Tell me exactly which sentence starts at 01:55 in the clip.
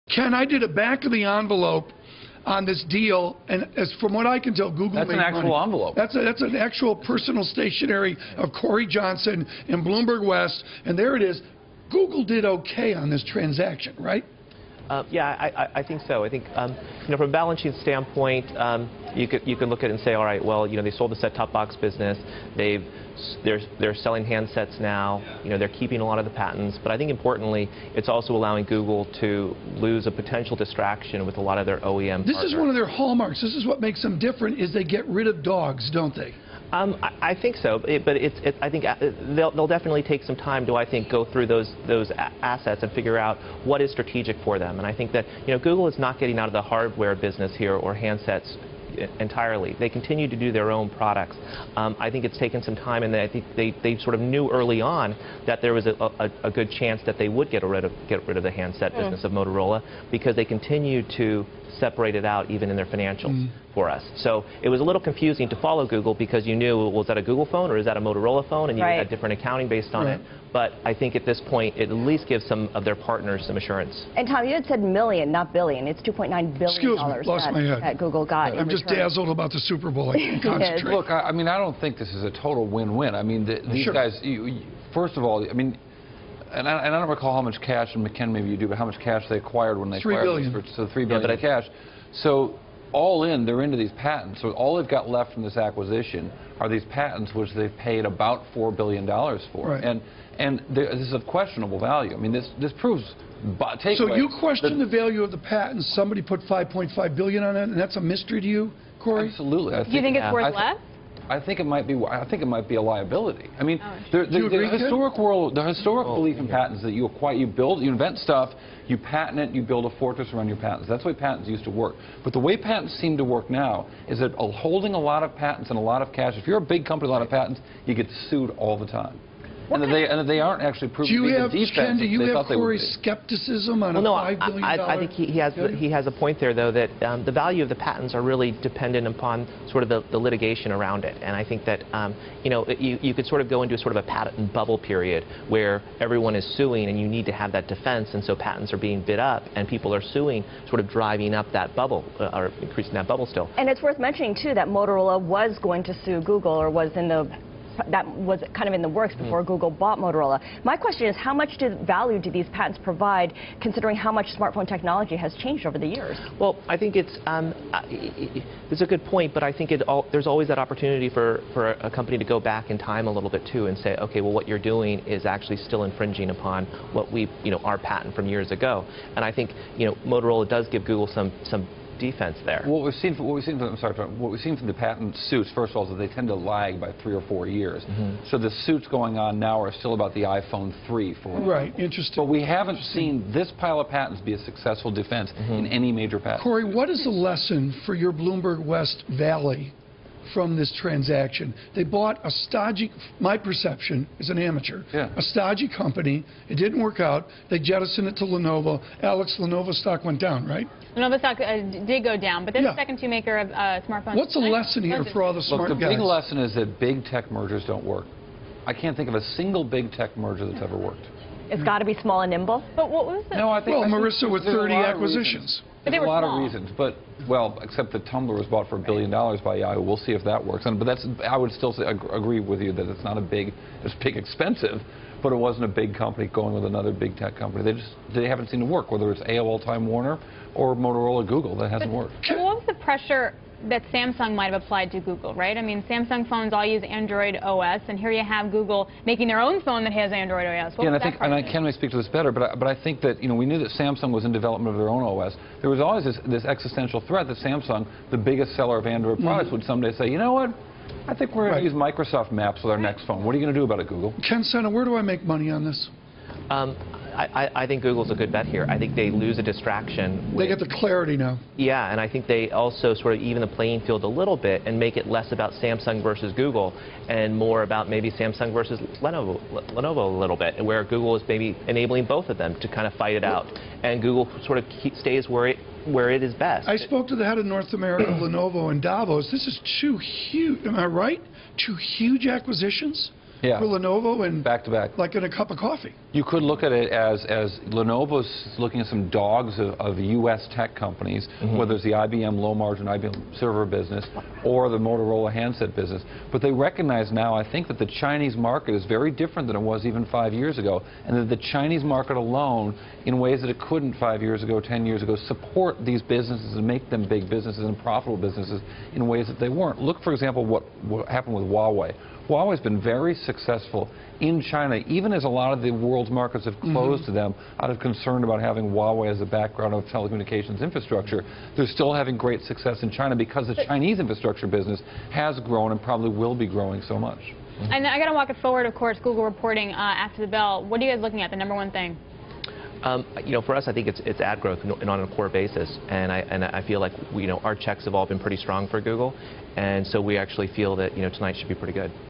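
world, the historic oh, belief in yeah.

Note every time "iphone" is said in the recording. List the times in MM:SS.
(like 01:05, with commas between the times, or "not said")
03:10.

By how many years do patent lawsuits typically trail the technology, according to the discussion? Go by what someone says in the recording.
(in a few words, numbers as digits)
3 or 4 years.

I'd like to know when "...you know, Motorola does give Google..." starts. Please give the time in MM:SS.
02:59.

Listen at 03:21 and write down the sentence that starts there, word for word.
They bought a stodgy, my perception is an amateur, yeah.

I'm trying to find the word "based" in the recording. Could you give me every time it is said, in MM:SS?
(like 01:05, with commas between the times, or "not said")
01:09.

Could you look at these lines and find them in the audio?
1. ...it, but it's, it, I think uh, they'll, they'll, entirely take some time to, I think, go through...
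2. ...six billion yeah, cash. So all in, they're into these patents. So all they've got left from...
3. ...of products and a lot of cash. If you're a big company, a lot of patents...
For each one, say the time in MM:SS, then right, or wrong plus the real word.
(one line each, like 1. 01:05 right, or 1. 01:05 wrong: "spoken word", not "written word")
1. 00:37 wrong: "definitely", not "entirely"
2. 01:30 wrong: "three", not "six"
3. 02:05 wrong: "patents", not "products".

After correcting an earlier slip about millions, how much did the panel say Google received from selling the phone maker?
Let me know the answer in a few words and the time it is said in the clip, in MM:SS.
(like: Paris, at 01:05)
$2.9 billion, at 01:16.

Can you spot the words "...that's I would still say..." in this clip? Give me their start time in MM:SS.
03:50.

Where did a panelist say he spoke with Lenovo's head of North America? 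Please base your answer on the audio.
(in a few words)
Davos.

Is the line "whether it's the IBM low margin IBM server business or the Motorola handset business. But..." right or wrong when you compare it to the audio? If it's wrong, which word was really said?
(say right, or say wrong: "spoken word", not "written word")
right.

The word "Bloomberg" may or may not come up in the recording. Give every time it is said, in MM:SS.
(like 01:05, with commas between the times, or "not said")
00:09, 03:18.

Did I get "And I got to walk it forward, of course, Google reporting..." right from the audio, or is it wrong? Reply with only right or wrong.
right.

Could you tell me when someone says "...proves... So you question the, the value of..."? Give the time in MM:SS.
01:42.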